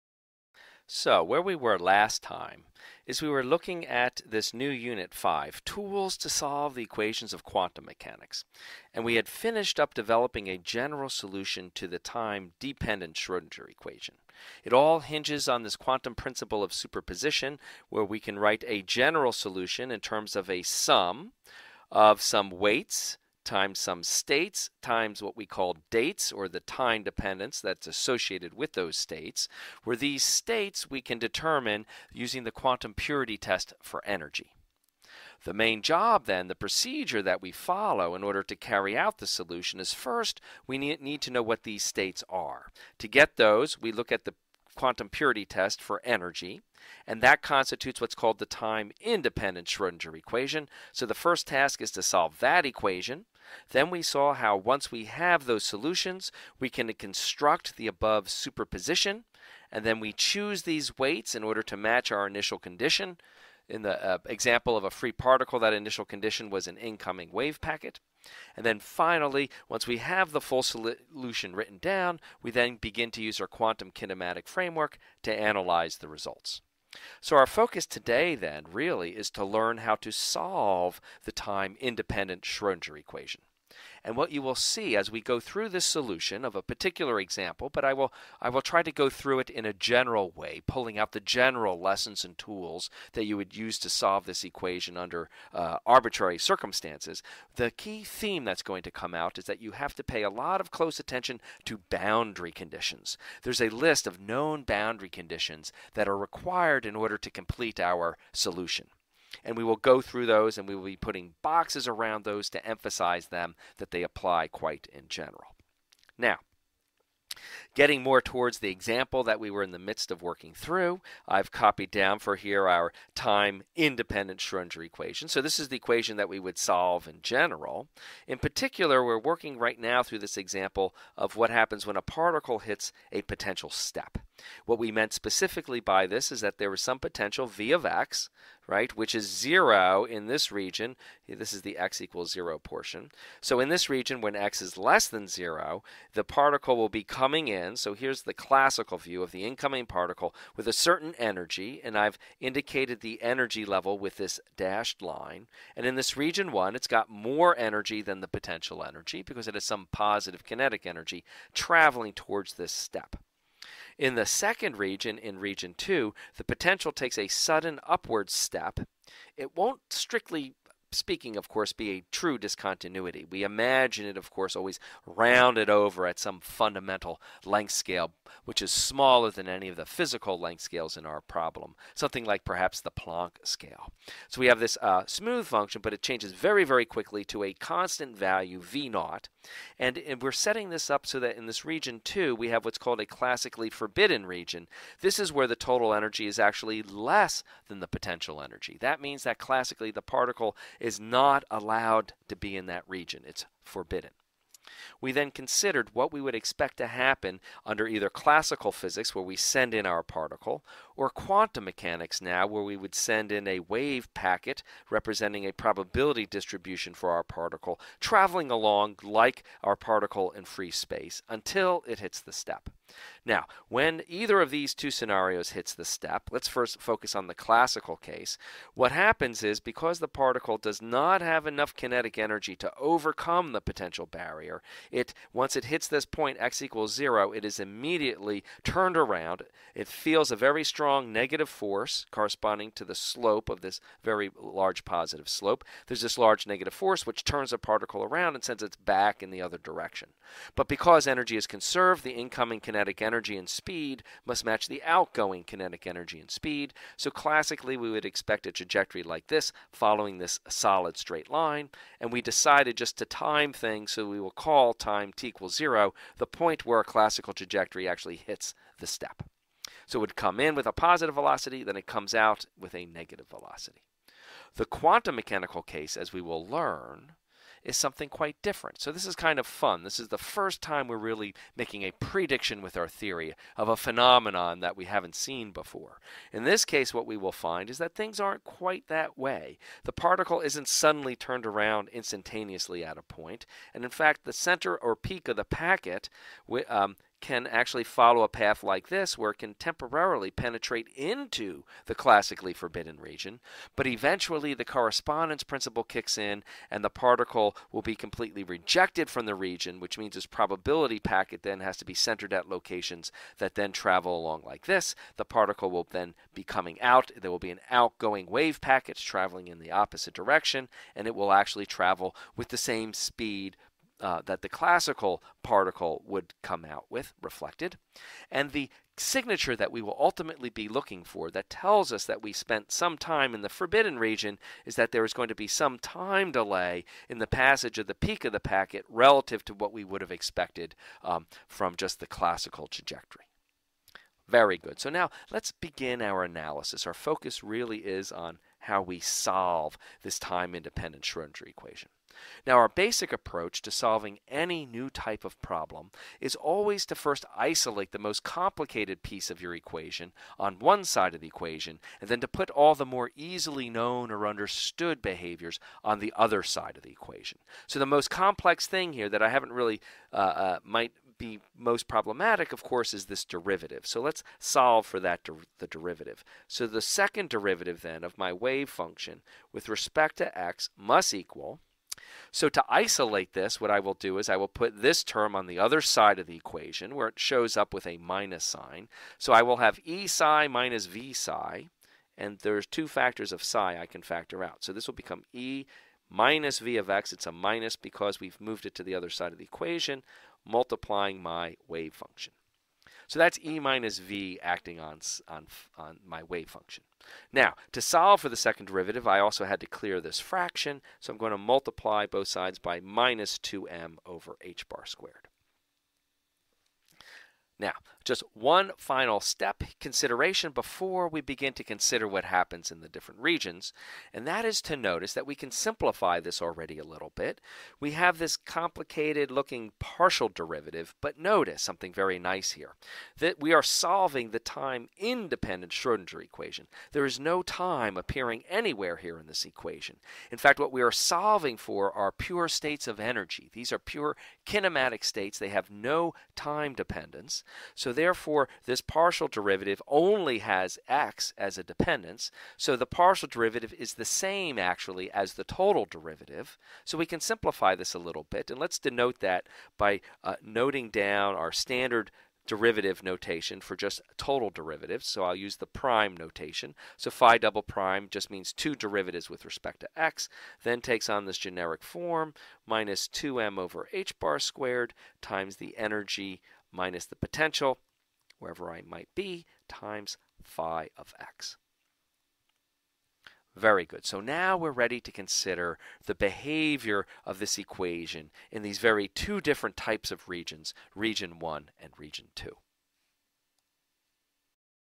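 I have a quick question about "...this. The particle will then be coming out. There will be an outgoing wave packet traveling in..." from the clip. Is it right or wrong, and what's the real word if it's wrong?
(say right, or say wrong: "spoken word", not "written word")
right.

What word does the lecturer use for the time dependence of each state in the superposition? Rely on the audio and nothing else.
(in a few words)
dates.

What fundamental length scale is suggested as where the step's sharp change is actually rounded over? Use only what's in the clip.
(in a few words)
The Planck scale.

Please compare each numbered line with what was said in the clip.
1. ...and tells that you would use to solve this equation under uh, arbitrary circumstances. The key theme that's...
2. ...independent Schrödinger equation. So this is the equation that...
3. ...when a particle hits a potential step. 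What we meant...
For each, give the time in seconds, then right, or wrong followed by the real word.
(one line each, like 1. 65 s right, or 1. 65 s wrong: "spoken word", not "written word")
1. 92 s wrong: "tools", not "tells"
2. 123 s right
3. 131 s right.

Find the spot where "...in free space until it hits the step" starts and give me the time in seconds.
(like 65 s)
220 s.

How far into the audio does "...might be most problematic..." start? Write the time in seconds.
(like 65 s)
370 s.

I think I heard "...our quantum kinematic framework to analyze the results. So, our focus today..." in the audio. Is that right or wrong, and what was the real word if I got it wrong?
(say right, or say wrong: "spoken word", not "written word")
right.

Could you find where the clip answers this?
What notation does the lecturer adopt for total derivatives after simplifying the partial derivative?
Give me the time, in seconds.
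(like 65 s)
465 s.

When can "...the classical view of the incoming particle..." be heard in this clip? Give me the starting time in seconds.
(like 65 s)
148 s.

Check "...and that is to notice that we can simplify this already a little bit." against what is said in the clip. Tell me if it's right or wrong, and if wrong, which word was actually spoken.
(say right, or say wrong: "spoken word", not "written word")
right.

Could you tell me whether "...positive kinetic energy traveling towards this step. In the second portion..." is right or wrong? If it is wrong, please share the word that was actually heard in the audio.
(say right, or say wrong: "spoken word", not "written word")
wrong: "region", not "portion".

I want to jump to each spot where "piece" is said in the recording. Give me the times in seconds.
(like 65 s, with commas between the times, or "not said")
359 s.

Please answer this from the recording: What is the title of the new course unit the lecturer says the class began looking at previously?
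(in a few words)
Tools to Solve the Equations of Quantum Mechanics.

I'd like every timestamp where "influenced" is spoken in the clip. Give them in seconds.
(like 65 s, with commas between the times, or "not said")
not said.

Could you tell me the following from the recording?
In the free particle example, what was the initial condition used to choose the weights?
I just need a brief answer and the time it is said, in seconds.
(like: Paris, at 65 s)
An incoming wave packet, at 66 s.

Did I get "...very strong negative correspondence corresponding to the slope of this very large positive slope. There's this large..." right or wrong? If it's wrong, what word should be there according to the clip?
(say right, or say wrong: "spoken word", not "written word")
wrong: "force", not "correspondence".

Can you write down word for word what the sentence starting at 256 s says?
So classically, we would expect a trajectory like this following this solid straight line.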